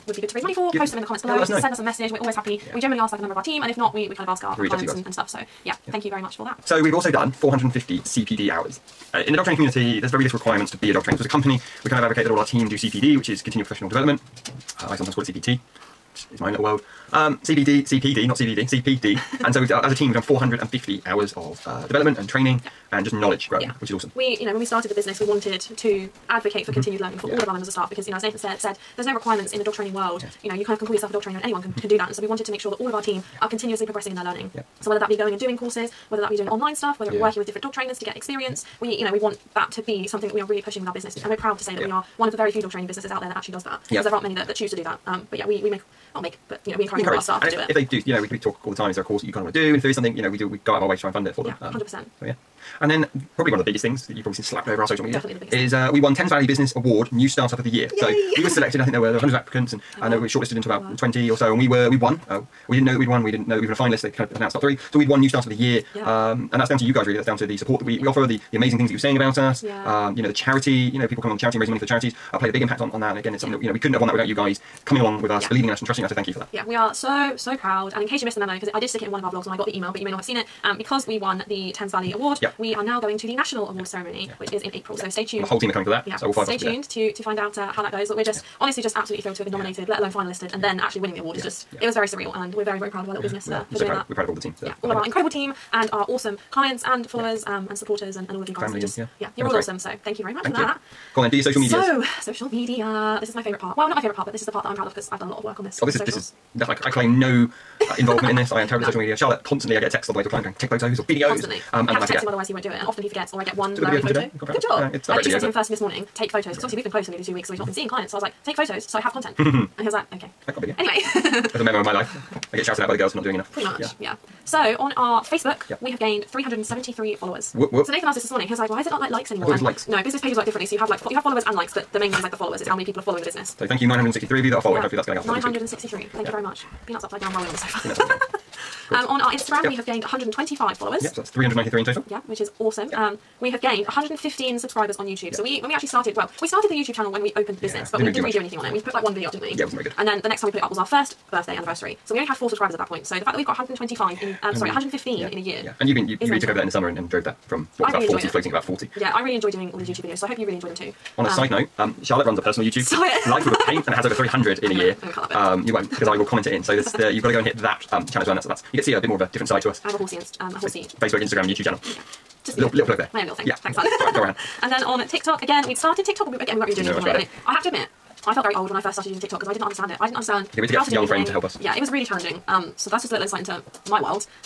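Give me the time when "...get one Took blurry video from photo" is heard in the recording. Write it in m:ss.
1:53.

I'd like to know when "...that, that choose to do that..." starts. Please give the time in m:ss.
0:44.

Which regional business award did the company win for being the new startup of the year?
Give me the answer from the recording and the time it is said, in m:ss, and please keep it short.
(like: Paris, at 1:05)
Thames Valley Business Award, at 0:56.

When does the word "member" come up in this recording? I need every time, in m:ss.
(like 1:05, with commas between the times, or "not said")
0:03, 0:27.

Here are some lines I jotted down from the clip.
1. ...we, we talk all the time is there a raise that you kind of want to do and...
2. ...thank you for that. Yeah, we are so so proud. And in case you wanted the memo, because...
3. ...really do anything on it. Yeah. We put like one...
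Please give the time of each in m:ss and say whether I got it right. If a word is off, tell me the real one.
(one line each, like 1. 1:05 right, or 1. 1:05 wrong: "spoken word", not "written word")
1. 0:48 wrong: "course", not "raise"
2. 1:16 wrong: "missed", not "wanted"
3. 2:28 right.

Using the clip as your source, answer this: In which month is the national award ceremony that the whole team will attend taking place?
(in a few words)
April.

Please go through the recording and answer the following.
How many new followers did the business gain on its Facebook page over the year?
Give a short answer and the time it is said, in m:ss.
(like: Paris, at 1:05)
373, at 2:06.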